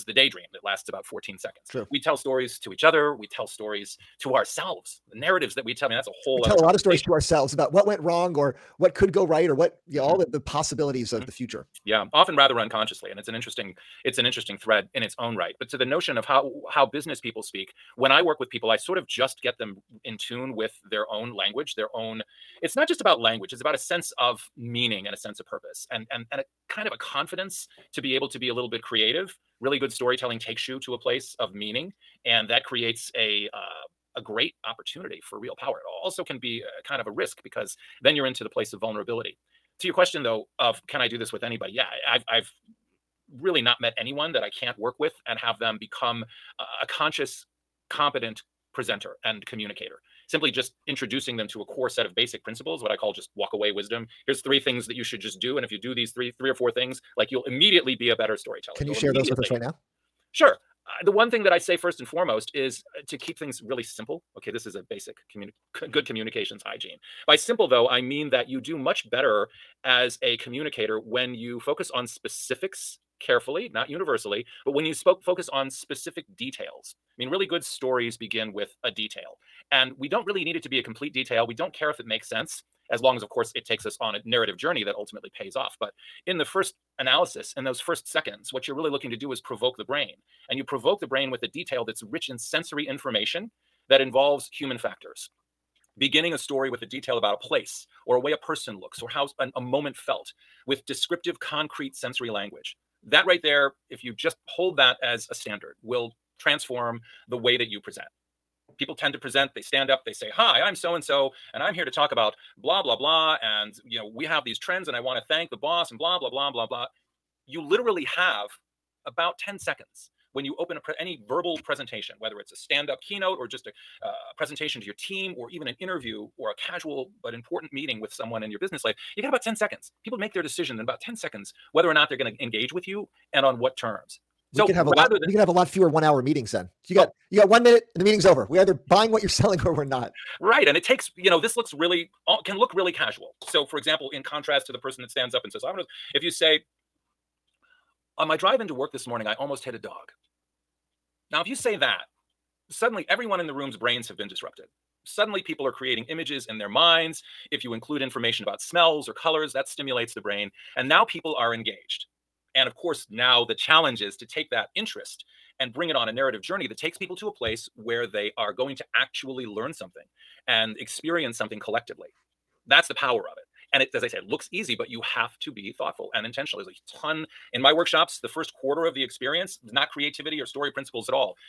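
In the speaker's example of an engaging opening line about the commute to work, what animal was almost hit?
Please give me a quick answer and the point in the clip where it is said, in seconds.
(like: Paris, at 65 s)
dog, at 149 s.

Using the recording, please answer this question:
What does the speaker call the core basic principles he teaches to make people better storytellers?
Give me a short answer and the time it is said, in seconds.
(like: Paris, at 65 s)
walk away wisdom, at 53 s.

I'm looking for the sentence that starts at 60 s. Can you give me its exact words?
Uh, the one thing that I say first and foremost is uh, to keep things really simple.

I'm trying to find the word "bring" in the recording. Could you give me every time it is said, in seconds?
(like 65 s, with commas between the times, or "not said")
165 s.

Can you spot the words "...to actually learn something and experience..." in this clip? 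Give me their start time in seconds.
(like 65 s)
168 s.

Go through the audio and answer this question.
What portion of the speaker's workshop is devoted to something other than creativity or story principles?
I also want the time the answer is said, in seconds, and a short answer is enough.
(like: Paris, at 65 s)
first quarter, at 178 s.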